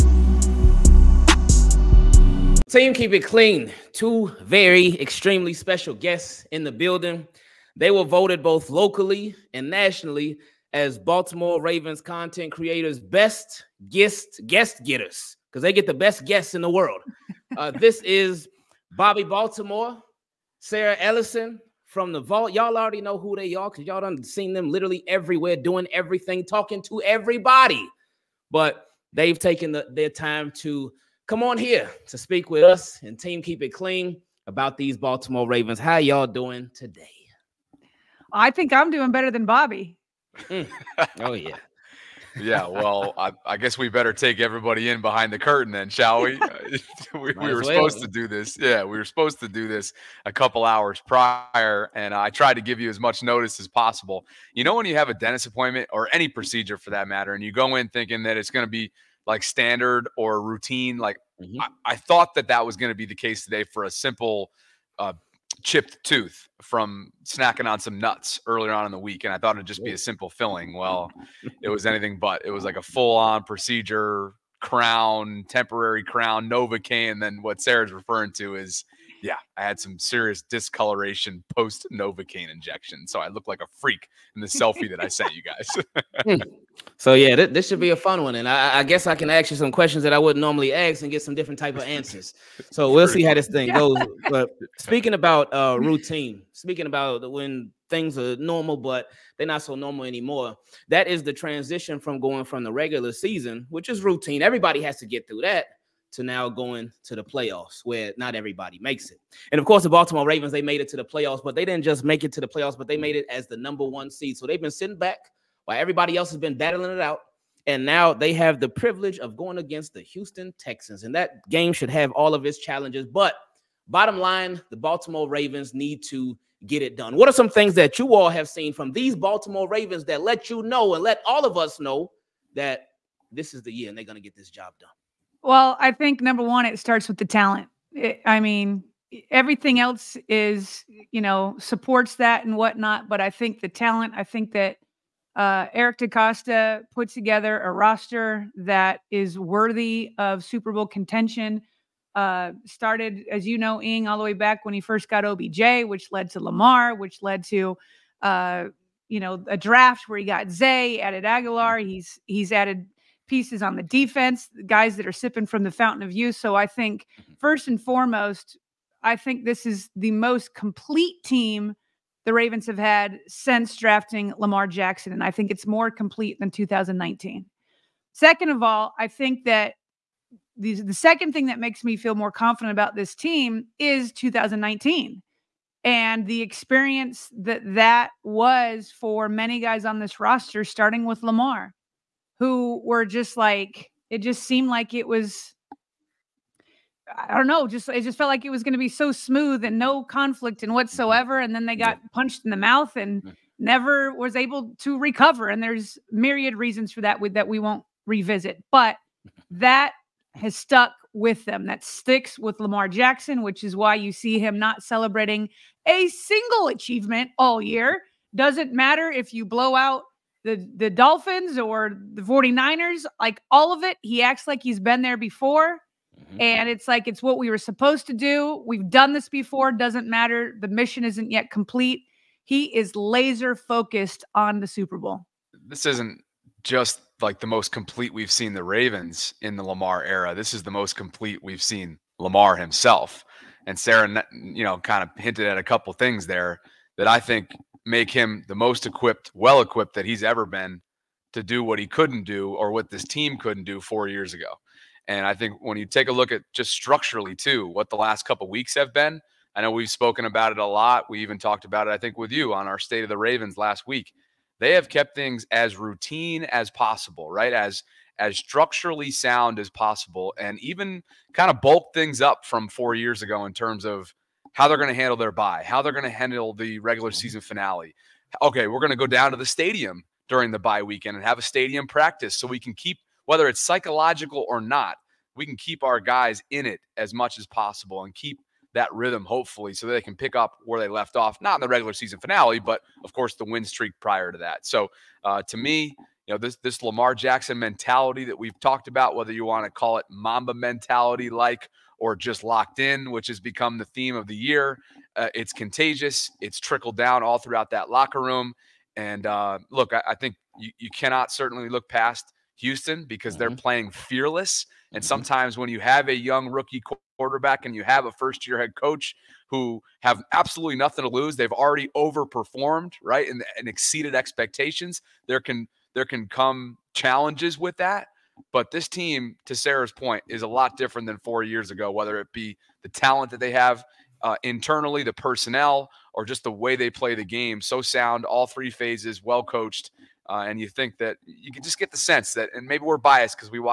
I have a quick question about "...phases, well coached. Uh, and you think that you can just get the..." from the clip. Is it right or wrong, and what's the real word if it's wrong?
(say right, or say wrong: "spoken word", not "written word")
right.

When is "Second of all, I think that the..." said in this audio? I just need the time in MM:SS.
02:58.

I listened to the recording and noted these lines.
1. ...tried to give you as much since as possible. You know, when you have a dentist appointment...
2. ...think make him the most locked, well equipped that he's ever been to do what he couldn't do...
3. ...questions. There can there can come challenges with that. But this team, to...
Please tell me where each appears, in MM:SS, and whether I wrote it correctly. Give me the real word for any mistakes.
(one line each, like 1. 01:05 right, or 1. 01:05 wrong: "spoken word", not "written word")
1. 00:52 wrong: "notice", not "since"
2. 04:07 wrong: "equipped", not "locked"
3. 05:24 wrong: "expectations", not "questions".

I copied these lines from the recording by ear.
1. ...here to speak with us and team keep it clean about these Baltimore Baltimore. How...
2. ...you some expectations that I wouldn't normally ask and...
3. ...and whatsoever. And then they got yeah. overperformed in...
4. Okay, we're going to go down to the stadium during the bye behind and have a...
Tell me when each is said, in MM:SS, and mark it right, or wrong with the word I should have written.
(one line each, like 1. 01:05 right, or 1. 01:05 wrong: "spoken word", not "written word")
1. 00:31 wrong: "Ravens", not "Baltimore"
2. 01:29 wrong: "questions", not "expectations"
3. 03:20 wrong: "punched", not "overperformed"
4. 04:38 wrong: "weekend", not "behind".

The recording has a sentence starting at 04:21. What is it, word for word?
We even talked about it, I think, with you on our State of the Ravens last week.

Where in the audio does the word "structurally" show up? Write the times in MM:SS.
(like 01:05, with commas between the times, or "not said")
04:16, 04:28.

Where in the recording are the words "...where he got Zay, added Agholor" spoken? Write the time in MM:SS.
02:40.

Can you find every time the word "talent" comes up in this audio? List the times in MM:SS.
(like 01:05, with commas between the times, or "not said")
02:17, 02:23, 05:32.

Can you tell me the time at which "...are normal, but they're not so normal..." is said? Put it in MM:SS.
01:38.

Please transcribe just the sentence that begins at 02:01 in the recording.
And that game should have all of its challenges.